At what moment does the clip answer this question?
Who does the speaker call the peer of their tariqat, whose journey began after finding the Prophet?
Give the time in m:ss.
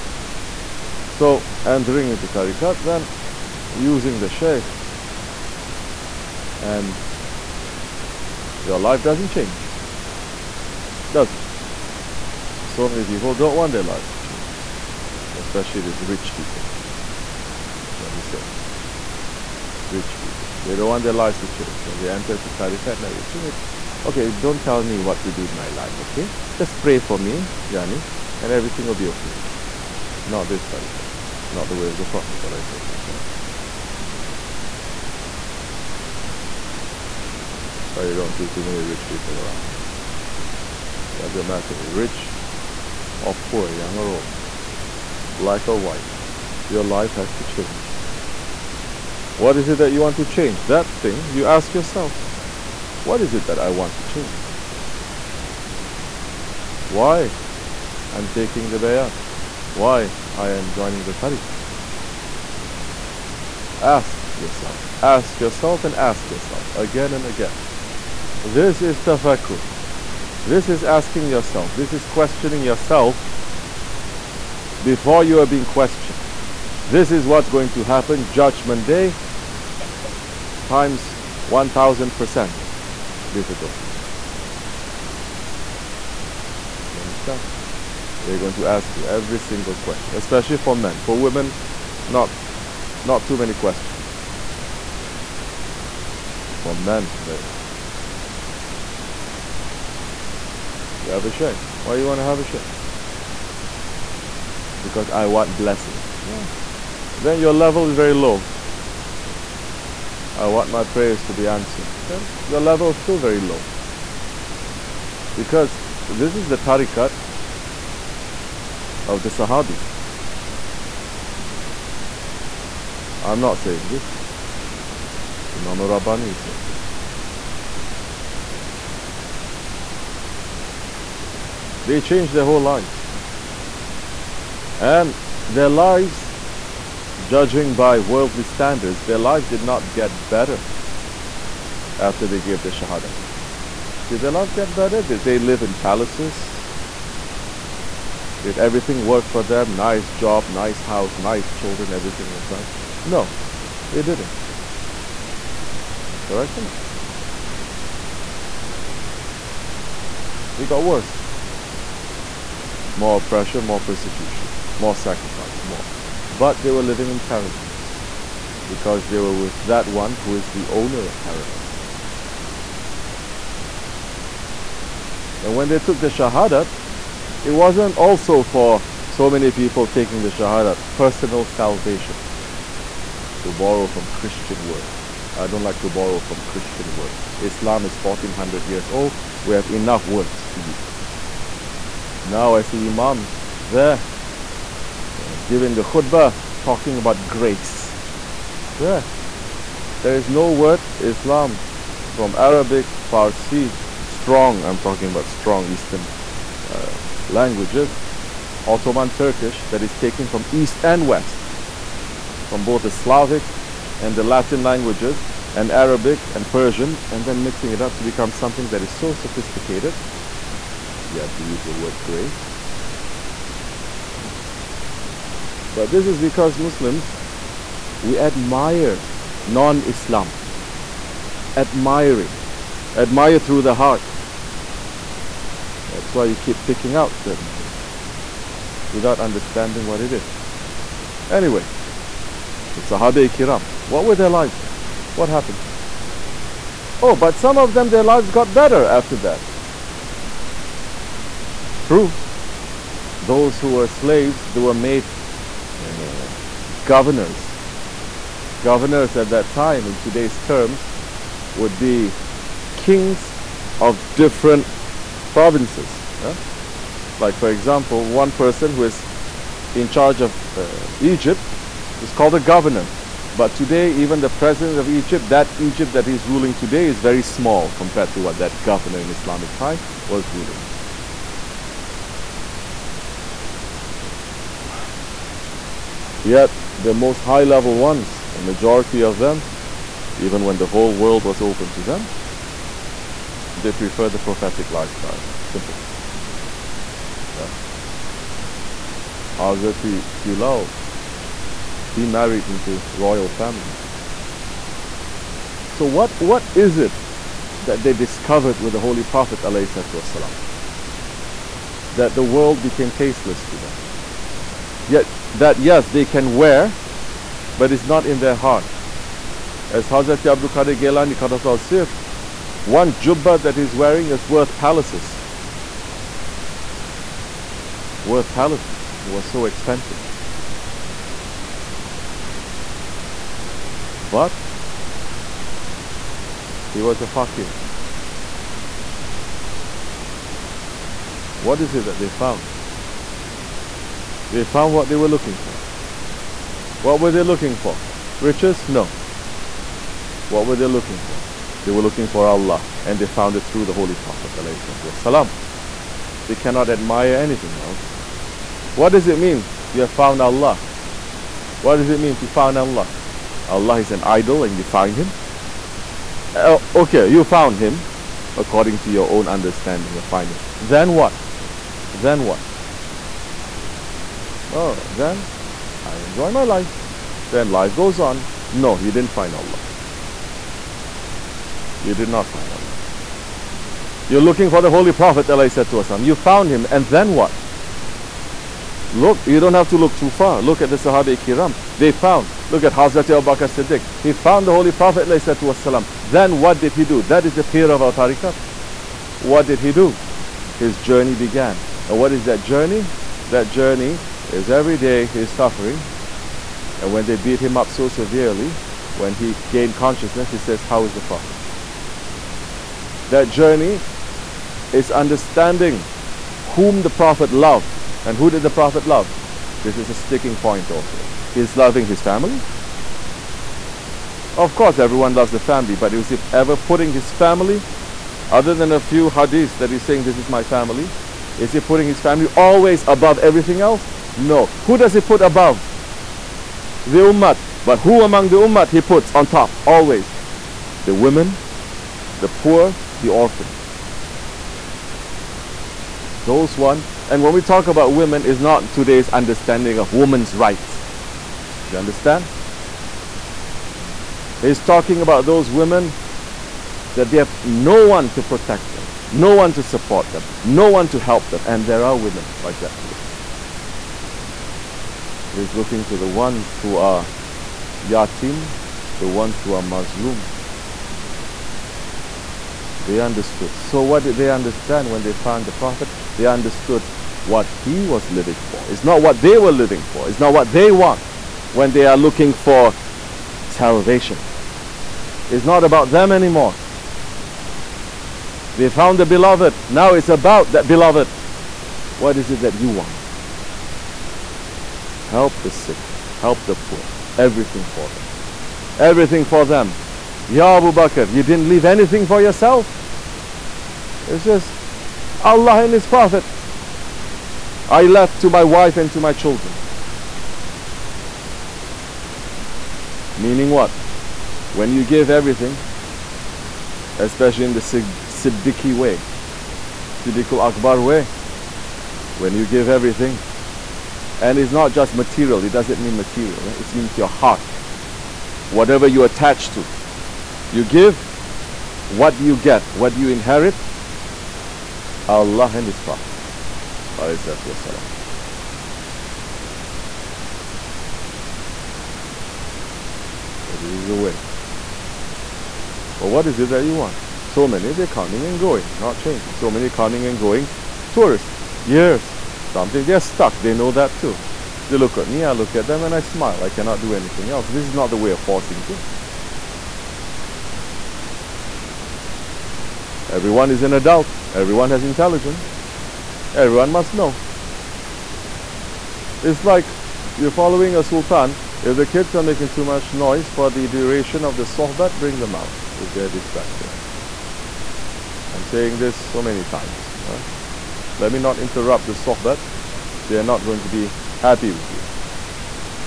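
6:33.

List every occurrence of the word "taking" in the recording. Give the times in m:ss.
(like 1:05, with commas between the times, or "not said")
0:58, 2:59.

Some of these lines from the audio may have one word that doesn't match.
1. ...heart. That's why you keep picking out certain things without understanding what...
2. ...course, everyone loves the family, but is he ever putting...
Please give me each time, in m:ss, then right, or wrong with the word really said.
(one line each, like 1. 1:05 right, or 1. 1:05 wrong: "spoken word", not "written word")
1. 3:53 right
2. 7:04 right.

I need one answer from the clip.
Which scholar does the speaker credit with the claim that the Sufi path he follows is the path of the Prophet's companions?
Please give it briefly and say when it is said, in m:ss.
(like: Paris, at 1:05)
Imam Rabbani, at 2:05.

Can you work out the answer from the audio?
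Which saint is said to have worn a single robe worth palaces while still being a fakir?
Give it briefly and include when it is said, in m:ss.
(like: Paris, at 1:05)
Abdul Qadir Gailani, at 5:20.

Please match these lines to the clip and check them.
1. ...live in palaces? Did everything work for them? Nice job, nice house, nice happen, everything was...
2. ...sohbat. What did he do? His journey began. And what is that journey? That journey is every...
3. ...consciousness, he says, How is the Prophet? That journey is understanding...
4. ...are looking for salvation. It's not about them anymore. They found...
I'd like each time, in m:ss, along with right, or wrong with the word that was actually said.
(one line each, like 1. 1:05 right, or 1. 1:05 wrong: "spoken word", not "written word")
1. 2:25 wrong: "children", not "happen"
2. 6:37 wrong: "tariqat", not "sohbat"
3. 6:49 right
4. 8:01 right.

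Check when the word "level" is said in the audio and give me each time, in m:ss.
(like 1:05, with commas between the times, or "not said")
1:47, 1:52, 4:47.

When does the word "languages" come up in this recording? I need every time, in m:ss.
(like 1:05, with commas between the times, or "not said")
3:27, 3:34.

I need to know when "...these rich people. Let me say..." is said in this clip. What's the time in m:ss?
0:15.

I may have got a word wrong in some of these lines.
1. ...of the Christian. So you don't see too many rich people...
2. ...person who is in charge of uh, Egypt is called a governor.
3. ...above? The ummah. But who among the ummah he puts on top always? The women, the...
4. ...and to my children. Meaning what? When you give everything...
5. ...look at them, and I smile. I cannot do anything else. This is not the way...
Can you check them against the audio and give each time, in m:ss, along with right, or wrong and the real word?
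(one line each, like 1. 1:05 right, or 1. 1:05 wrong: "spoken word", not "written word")
1. 0:31 wrong: "Prophet", not "Christian"
2. 4:28 right
3. 7:15 right
4. 8:28 right
5. 9:15 right.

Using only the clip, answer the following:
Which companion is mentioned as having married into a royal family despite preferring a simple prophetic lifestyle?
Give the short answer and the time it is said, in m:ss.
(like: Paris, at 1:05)
Hazrat Bilal, at 4:59.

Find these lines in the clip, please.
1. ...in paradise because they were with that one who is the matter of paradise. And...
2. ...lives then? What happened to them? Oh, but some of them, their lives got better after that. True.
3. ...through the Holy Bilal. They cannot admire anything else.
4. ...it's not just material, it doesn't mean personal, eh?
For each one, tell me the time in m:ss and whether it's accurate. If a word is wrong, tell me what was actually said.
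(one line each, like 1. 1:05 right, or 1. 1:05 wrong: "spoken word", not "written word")
1. 2:47 wrong: "owner", not "matter"
2. 4:04 right
3. 5:53 wrong: "Prophet", not "Bilal"
4. 8:44 wrong: "material", not "personal".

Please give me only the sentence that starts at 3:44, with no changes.
What was but this is because Muslims, we admire non Islam.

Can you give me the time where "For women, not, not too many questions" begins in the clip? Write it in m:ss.
1:31.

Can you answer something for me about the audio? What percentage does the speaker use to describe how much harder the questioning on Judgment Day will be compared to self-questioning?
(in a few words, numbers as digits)
1000%.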